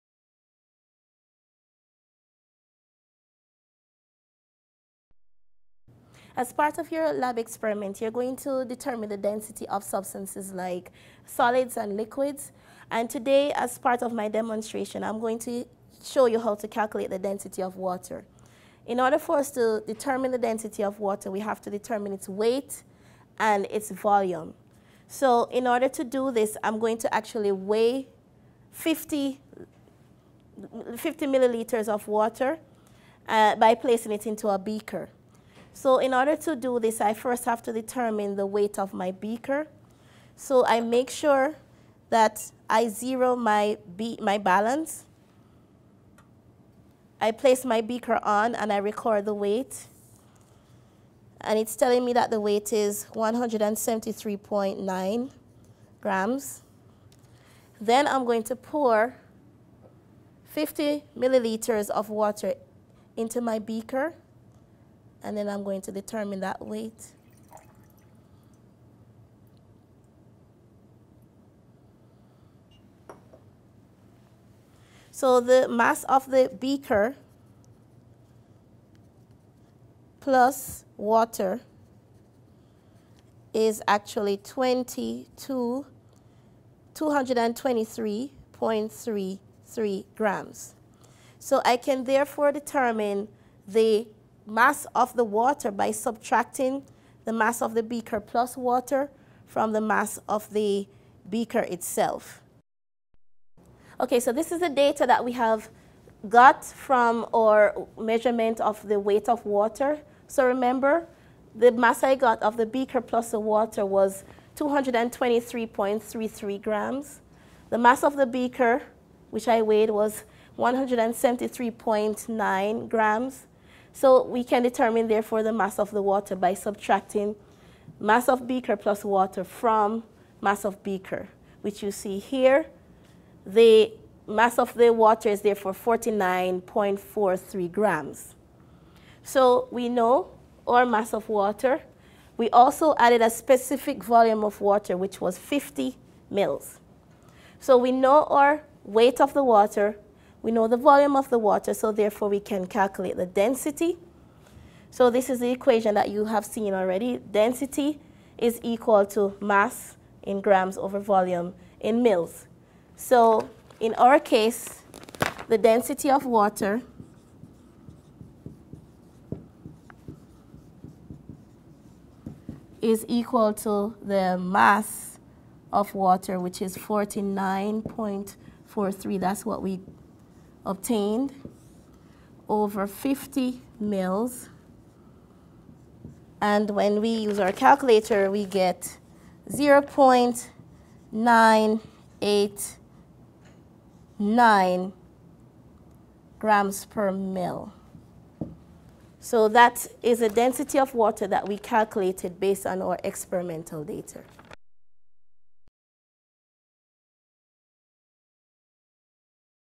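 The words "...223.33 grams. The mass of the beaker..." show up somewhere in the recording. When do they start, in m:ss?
1:54.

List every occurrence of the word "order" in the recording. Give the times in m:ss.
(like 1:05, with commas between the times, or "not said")
0:18, 0:25, 0:36.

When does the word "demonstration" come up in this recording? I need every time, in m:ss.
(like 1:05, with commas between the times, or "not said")
0:14.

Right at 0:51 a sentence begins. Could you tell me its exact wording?
And it's telling me that the weight is 173.9 grams.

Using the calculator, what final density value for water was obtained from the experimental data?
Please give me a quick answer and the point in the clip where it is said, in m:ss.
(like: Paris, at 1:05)
0.989 grams per mL, at 3:09.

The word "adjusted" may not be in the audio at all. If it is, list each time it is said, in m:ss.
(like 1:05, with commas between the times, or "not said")
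not said.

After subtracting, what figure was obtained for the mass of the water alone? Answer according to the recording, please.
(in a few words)
49.43 grams.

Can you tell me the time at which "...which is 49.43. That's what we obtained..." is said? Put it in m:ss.
2:56.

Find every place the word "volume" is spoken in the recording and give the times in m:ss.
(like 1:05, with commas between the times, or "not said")
0:23, 2:24, 2:30, 2:40.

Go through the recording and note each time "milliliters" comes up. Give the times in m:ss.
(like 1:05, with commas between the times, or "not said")
0:31, 1:01.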